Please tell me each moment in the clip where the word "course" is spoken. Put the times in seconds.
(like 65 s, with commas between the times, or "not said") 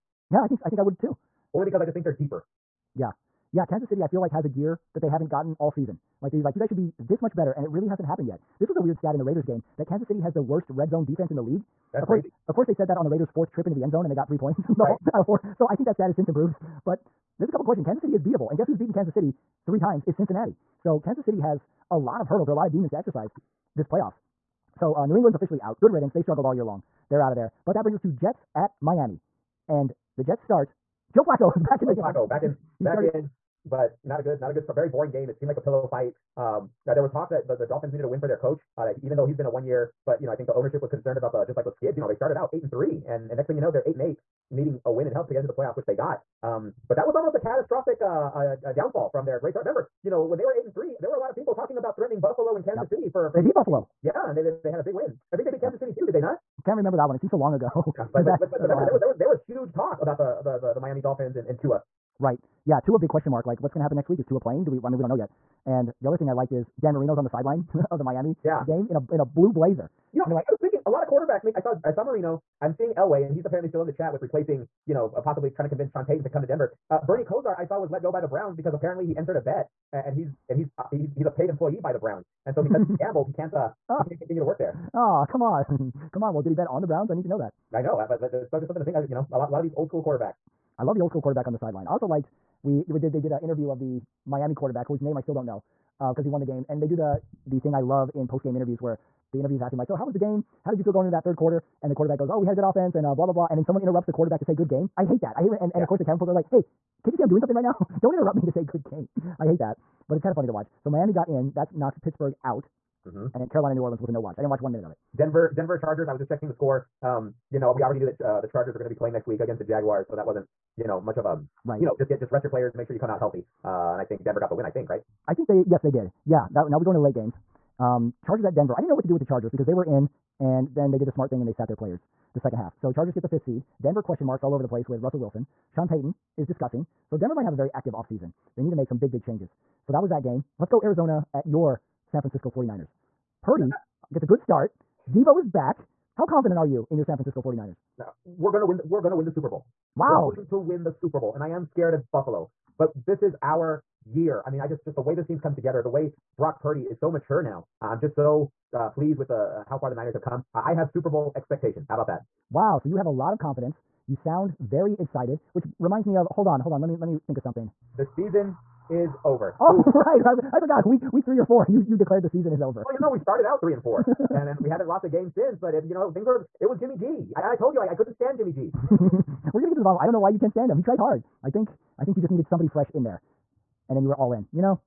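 12 s, 105 s.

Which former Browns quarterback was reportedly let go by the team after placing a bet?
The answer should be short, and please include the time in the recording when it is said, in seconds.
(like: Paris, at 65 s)
Bernie Kosar, at 77 s.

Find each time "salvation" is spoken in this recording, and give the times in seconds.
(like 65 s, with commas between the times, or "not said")
not said.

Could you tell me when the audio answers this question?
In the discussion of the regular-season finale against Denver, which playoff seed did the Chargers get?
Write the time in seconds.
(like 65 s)
133 s.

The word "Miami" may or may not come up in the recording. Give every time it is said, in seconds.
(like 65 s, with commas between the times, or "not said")
28 s, 60 s, 68 s, 94 s, 110 s.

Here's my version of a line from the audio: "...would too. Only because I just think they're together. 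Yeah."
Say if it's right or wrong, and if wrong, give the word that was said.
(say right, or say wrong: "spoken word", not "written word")
wrong: "deeper", not "together".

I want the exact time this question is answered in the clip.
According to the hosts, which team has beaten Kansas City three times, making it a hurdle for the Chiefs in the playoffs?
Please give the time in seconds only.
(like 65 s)
20 s.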